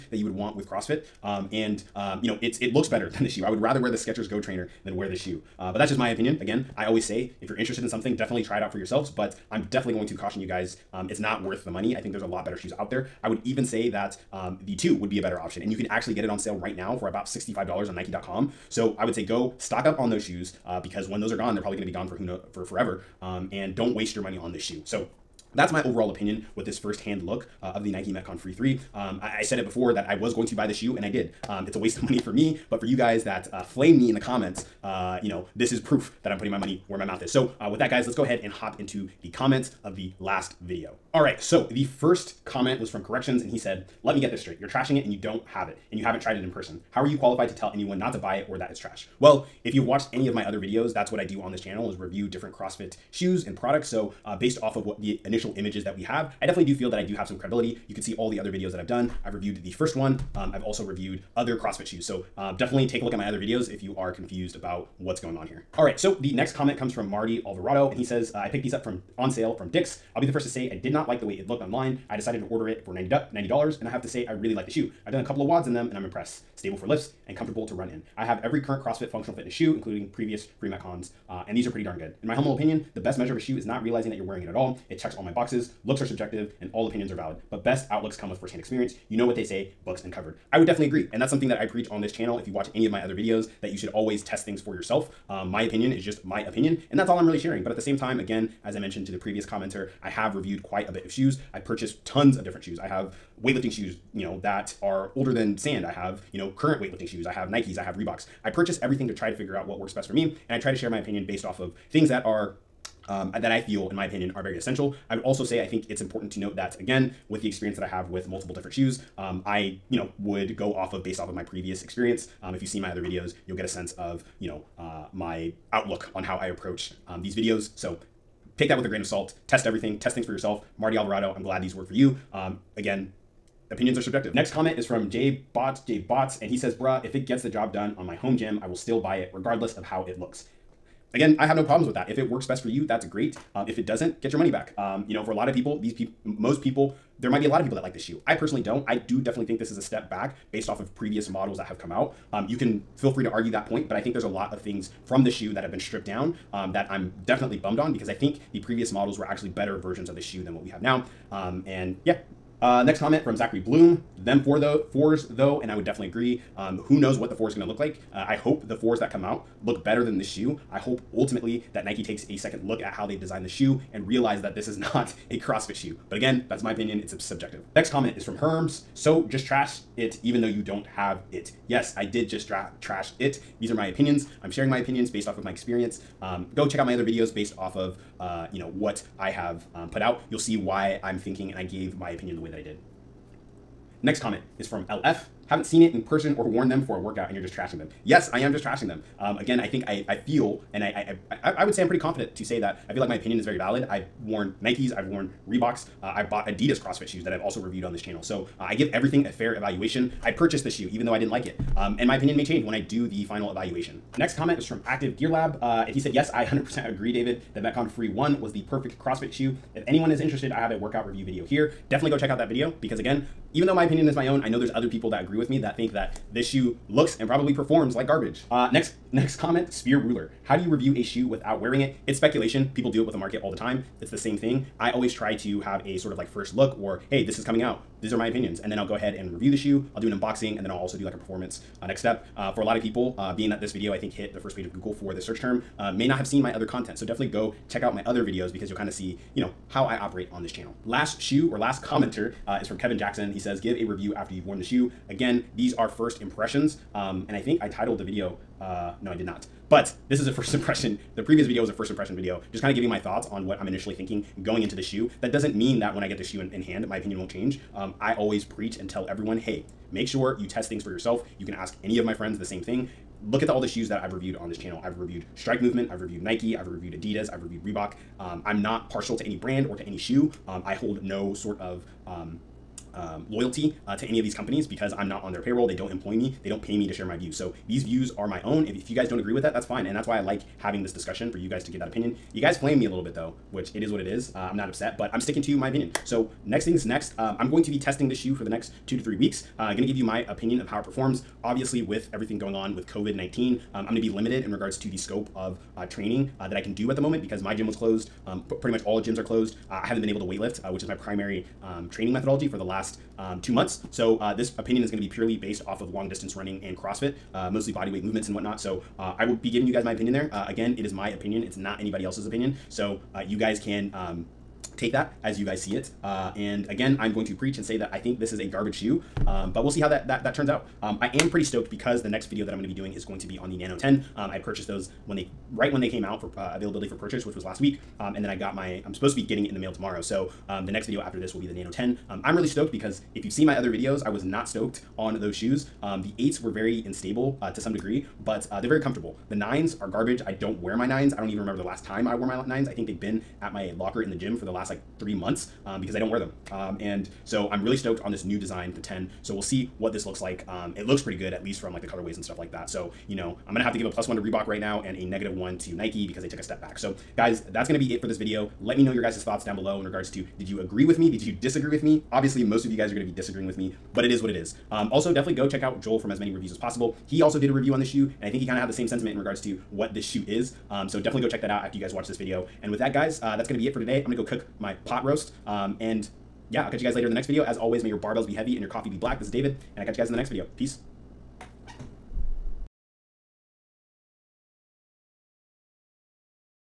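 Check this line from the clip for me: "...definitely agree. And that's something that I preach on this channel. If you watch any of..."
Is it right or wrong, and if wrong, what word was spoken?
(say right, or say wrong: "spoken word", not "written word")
right.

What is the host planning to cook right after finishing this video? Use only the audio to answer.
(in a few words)
pot roast.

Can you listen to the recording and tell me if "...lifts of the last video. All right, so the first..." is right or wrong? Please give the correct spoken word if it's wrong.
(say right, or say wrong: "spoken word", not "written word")
wrong: "comments", not "lifts".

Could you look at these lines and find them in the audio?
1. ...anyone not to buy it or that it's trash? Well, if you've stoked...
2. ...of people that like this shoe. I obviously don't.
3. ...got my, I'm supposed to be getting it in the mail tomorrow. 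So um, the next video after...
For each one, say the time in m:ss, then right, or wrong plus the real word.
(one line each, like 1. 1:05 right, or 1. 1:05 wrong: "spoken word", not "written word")
1. 0:47 wrong: "watched", not "stoked"
2. 2:27 wrong: "personally", not "obviously"
3. 5:38 right.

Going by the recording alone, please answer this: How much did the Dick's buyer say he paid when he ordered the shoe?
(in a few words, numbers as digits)
$90.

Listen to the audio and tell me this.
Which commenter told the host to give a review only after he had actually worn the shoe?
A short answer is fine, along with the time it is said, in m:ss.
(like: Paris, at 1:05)
Kevin Jackson, at 4:12.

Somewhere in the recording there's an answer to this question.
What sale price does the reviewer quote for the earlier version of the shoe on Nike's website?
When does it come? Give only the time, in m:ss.
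0:17.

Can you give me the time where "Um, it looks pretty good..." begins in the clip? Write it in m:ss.
6:00.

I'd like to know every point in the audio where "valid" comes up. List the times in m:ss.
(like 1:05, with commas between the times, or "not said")
1:27, 3:23.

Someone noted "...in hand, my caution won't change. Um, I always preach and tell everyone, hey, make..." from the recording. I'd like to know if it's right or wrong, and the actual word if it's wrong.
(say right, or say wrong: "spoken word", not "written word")
wrong: "opinion", not "caution".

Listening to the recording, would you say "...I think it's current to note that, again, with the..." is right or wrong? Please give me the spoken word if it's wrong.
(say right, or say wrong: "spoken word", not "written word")
wrong: "important", not "current".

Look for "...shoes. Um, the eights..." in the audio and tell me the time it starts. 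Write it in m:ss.
5:45.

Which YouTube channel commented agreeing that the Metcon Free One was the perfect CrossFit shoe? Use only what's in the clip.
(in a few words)
Active Gear Lab.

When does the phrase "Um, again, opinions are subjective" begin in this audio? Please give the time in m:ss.
2:12.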